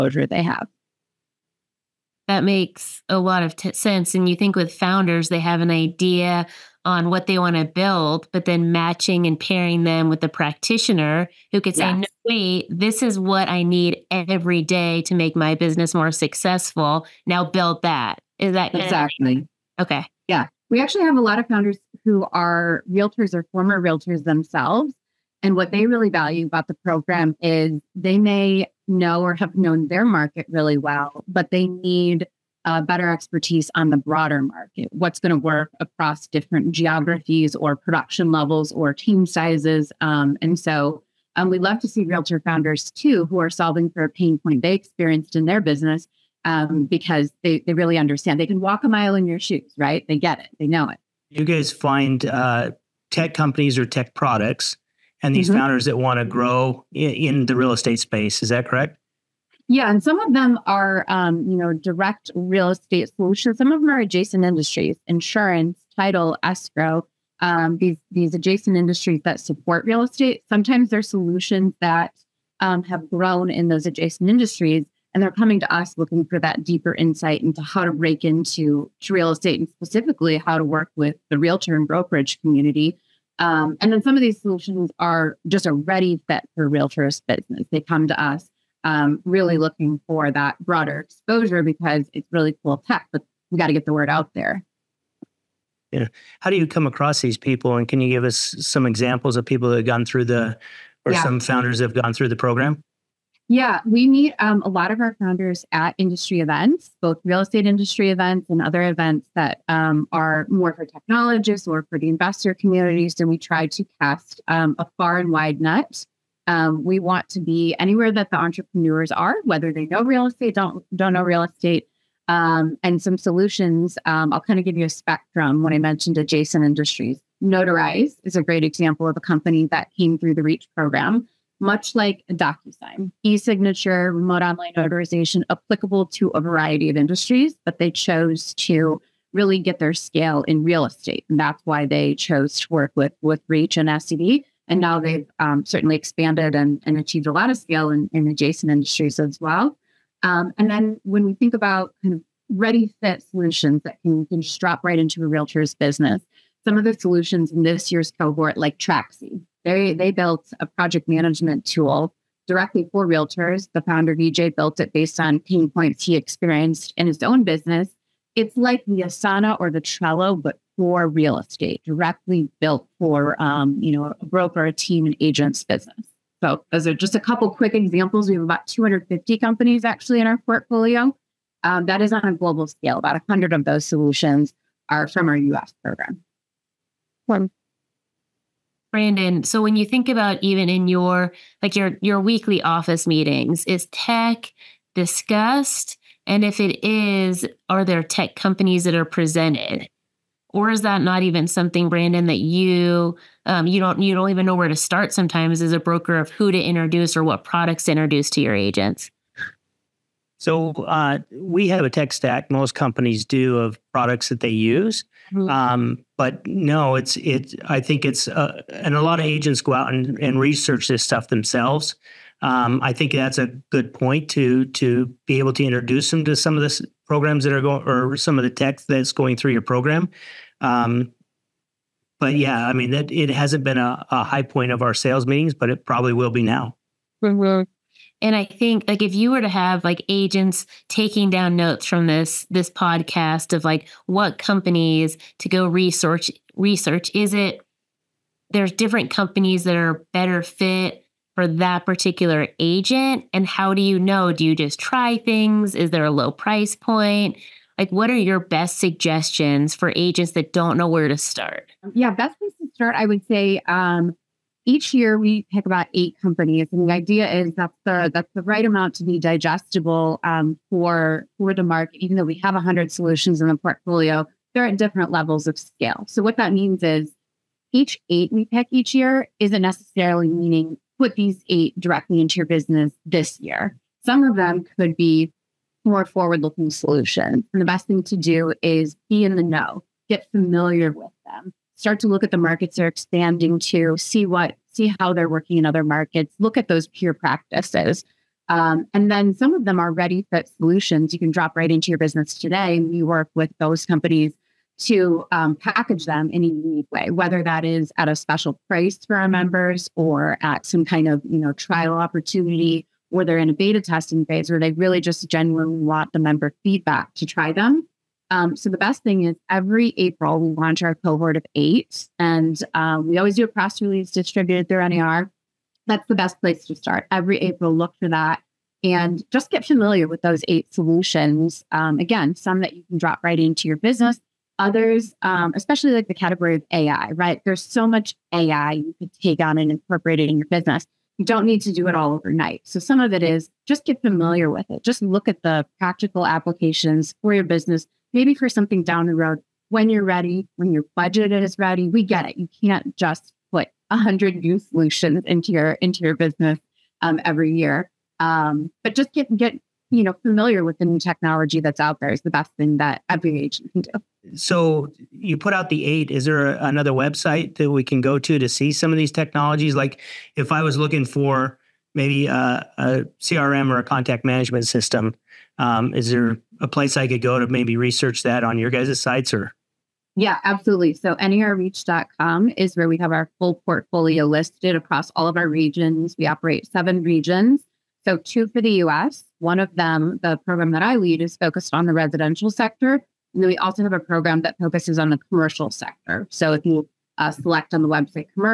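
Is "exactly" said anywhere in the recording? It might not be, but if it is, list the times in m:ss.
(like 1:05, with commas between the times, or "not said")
0:18.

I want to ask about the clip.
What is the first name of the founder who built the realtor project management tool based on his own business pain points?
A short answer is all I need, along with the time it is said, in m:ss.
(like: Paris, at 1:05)
VJ, at 2:44.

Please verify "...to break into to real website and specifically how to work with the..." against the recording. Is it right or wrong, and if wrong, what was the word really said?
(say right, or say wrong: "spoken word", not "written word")
wrong: "estate", not "website".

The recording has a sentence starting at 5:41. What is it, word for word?
You don't need to do it all overnight.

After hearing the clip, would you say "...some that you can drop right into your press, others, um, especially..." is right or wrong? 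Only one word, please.
wrong.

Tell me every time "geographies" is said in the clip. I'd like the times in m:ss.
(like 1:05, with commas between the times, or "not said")
0:36.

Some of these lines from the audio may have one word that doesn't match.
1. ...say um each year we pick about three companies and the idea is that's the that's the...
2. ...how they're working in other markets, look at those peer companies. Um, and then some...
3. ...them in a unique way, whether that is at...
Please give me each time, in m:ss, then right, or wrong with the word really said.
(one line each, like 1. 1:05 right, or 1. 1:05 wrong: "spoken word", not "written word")
1. 4:23 wrong: "eight", not "three"
2. 4:54 wrong: "practices", not "companies"
3. 5:06 right.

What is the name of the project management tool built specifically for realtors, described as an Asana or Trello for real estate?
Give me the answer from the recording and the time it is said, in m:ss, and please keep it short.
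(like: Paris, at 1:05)
Trackxi, at 2:38.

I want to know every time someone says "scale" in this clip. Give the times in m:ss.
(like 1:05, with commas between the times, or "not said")
2:19, 2:27, 3:02, 4:35.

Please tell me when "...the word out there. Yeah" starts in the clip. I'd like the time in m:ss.
1:33.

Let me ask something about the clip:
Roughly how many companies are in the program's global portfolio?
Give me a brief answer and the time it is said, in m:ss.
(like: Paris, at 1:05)
250, at 2:58.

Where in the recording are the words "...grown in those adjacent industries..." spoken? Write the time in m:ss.
1:13.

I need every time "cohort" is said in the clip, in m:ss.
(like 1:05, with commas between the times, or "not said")
2:38, 5:20.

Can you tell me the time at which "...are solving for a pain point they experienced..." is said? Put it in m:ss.
0:43.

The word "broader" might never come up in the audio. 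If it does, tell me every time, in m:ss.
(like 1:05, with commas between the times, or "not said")
0:33, 1:30.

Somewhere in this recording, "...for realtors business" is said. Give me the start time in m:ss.
1:26.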